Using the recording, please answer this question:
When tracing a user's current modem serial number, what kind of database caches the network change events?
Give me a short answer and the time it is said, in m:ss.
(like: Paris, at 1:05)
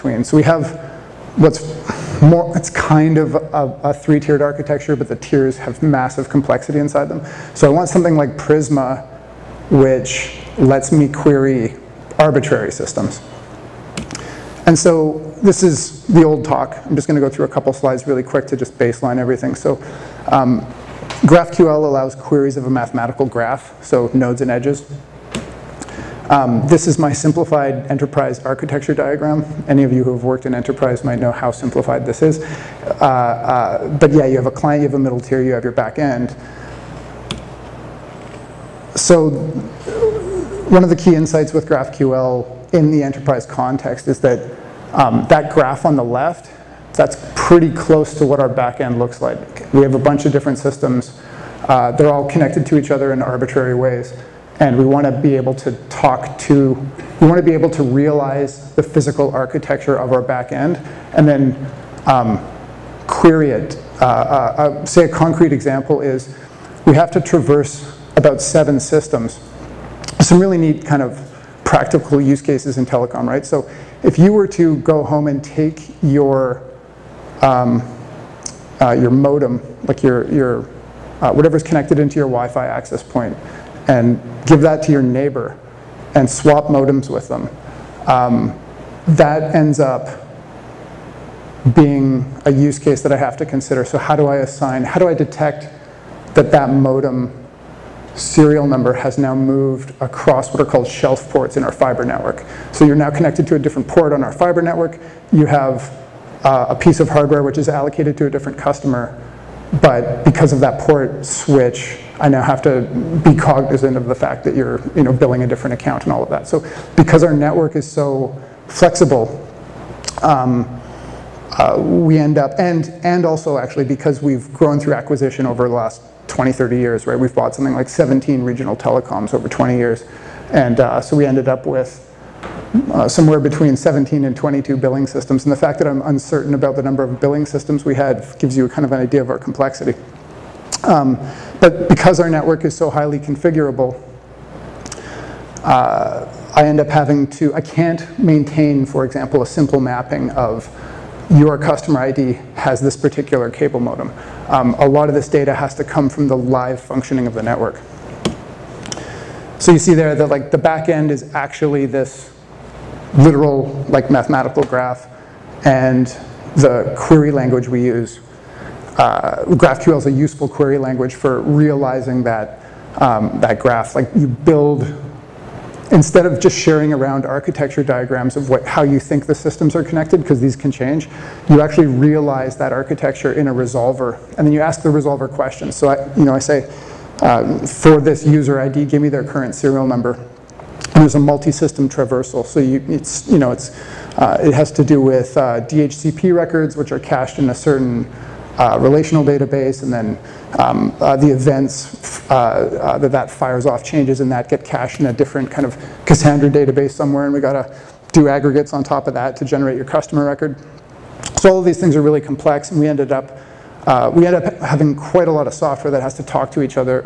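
Cassandra, at 3:26.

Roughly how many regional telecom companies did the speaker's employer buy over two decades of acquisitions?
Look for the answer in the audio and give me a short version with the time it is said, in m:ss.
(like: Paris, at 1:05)
17, at 2:07.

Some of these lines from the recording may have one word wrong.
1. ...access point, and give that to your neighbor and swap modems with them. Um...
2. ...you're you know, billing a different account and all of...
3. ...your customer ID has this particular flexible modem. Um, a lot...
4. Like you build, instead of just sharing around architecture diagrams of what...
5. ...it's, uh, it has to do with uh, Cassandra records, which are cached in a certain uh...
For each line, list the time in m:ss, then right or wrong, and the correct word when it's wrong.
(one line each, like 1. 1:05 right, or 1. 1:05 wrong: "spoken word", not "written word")
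1. 1:22 right
2. 1:54 right
3. 2:31 wrong: "cable", not "flexible"
4. 2:53 right
5. 3:13 wrong: "DHCP", not "Cassandra".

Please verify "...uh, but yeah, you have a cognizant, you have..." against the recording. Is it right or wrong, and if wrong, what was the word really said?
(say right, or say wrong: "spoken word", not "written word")
wrong: "client", not "cognizant".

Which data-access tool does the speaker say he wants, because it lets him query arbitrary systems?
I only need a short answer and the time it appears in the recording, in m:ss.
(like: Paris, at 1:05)
Prisma, at 0:08.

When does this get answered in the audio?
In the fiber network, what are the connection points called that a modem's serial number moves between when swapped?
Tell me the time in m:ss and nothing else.
1:40.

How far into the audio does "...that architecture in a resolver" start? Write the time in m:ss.
3:02.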